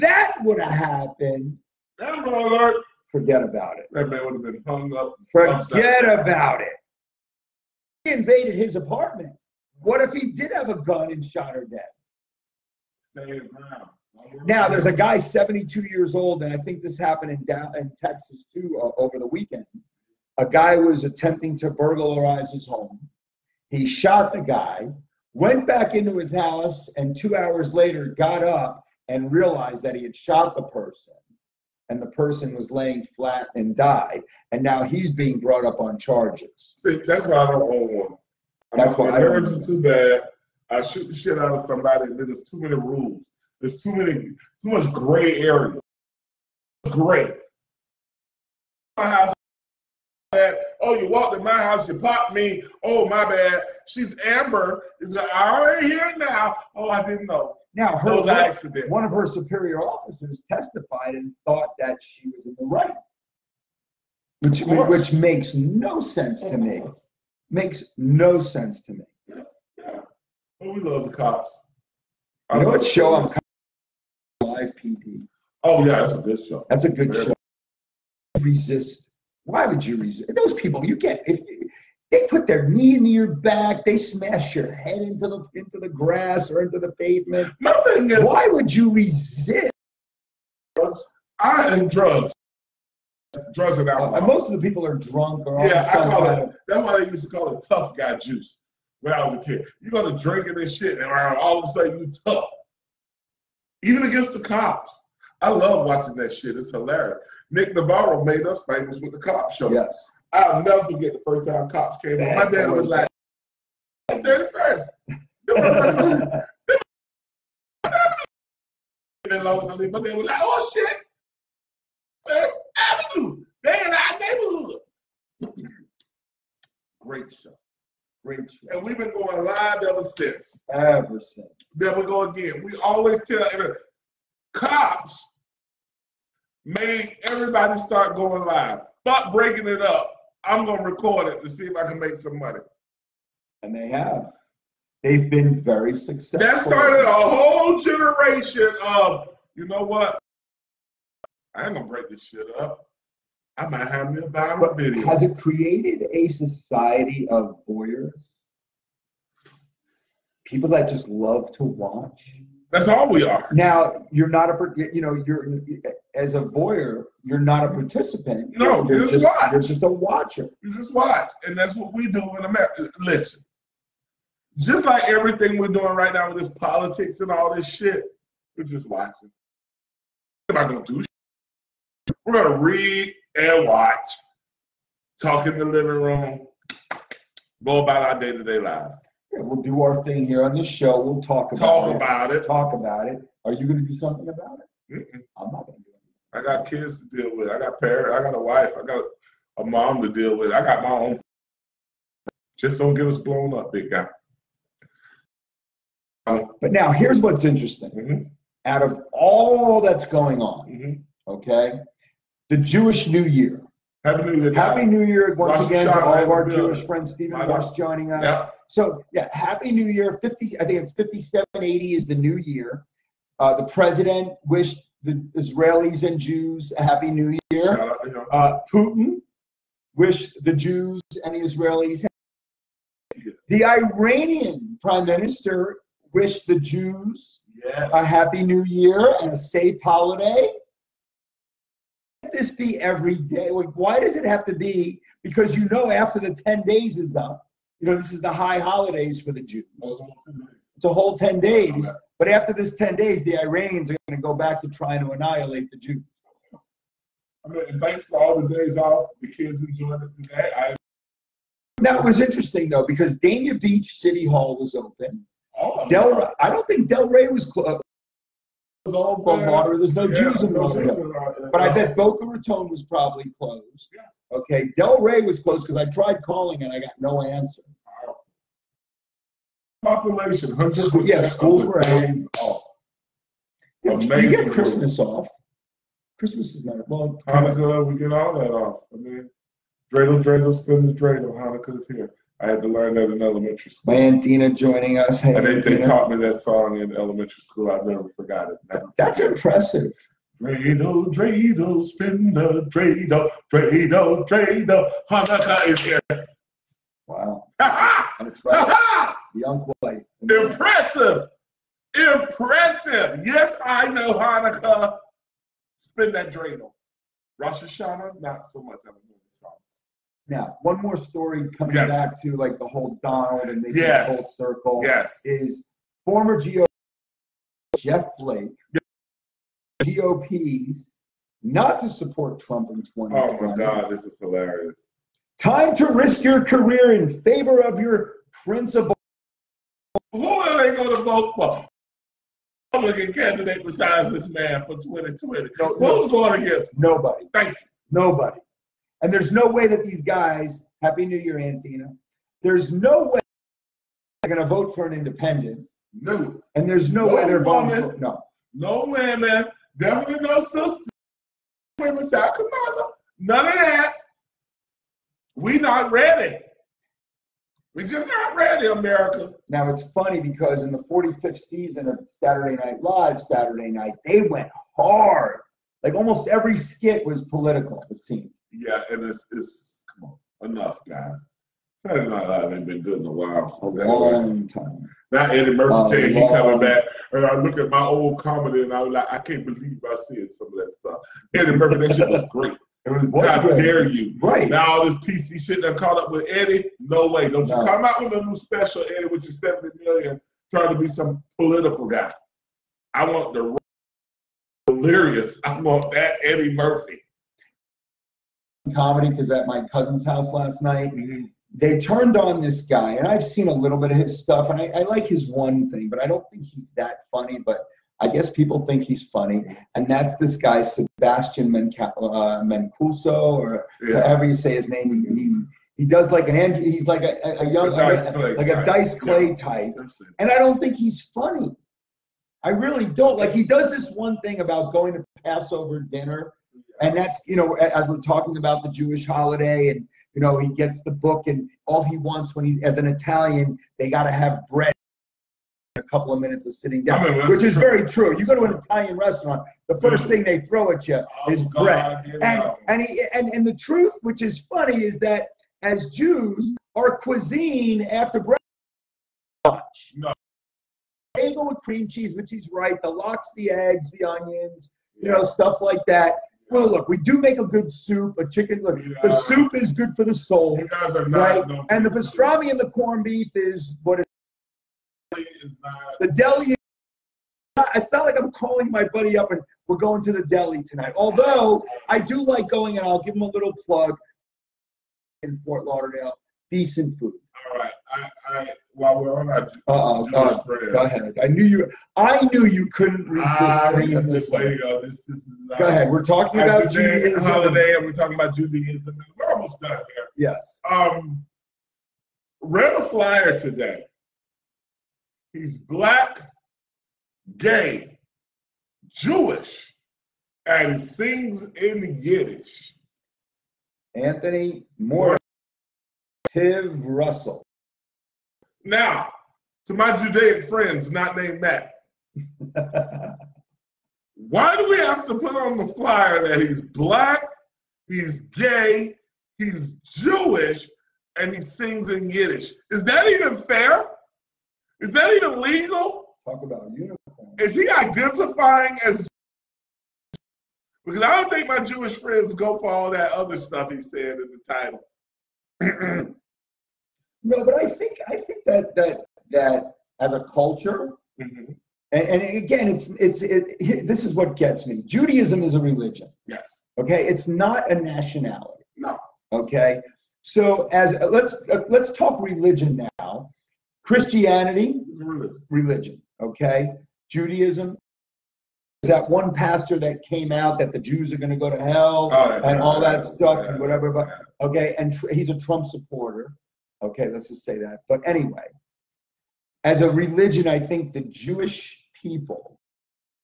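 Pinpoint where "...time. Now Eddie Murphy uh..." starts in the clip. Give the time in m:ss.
6:24.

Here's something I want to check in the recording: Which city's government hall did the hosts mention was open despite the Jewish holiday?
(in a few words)
Dania Beach.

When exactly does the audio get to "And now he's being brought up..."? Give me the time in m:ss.
0:34.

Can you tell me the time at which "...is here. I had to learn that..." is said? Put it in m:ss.
4:51.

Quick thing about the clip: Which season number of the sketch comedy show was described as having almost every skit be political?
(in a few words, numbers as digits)
45th.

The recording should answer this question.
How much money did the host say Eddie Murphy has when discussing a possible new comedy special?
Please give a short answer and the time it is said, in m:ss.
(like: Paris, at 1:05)
70 million, at 6:39.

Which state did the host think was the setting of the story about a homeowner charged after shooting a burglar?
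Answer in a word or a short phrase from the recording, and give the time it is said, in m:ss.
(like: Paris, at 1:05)
Texas, at 0:18.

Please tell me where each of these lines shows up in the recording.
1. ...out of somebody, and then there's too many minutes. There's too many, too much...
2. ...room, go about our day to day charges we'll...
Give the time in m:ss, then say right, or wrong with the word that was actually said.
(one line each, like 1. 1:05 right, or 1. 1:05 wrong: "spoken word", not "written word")
1. 0:41 wrong: "rules", not "minutes"
2. 3:06 wrong: "lives", not "charges".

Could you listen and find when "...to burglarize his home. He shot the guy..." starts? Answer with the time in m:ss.
0:21.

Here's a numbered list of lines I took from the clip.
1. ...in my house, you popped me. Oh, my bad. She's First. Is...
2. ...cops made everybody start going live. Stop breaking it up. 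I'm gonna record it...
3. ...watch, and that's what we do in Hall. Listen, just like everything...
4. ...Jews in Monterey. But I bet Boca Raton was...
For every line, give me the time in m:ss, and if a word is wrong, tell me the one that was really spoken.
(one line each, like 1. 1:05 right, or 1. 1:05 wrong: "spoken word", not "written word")
1. 0:51 wrong: "Amber", not "First"
2. 2:14 right
3. 2:50 wrong: "America", not "Hall"
4. 4:30 right.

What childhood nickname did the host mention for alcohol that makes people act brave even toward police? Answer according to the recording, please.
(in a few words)
tough guy juice.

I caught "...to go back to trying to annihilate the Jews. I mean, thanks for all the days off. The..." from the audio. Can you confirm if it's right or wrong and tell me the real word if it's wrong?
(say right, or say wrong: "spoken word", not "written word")
right.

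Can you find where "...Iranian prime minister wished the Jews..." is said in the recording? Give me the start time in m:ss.
3:53.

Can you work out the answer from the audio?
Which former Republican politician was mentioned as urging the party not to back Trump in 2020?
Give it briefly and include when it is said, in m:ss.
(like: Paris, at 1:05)
Jeff Flake, at 5:27.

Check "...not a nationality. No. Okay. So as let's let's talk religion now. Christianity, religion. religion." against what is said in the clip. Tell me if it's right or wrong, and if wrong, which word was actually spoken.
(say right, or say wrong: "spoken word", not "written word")
right.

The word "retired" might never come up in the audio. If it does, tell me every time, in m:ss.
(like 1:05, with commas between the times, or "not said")
not said.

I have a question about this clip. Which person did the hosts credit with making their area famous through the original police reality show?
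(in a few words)
Nick Navarro.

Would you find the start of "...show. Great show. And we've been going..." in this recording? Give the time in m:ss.
2:07.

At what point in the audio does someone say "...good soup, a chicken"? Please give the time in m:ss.
7:47.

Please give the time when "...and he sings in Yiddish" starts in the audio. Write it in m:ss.
8:51.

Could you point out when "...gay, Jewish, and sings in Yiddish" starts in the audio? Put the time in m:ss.
8:27.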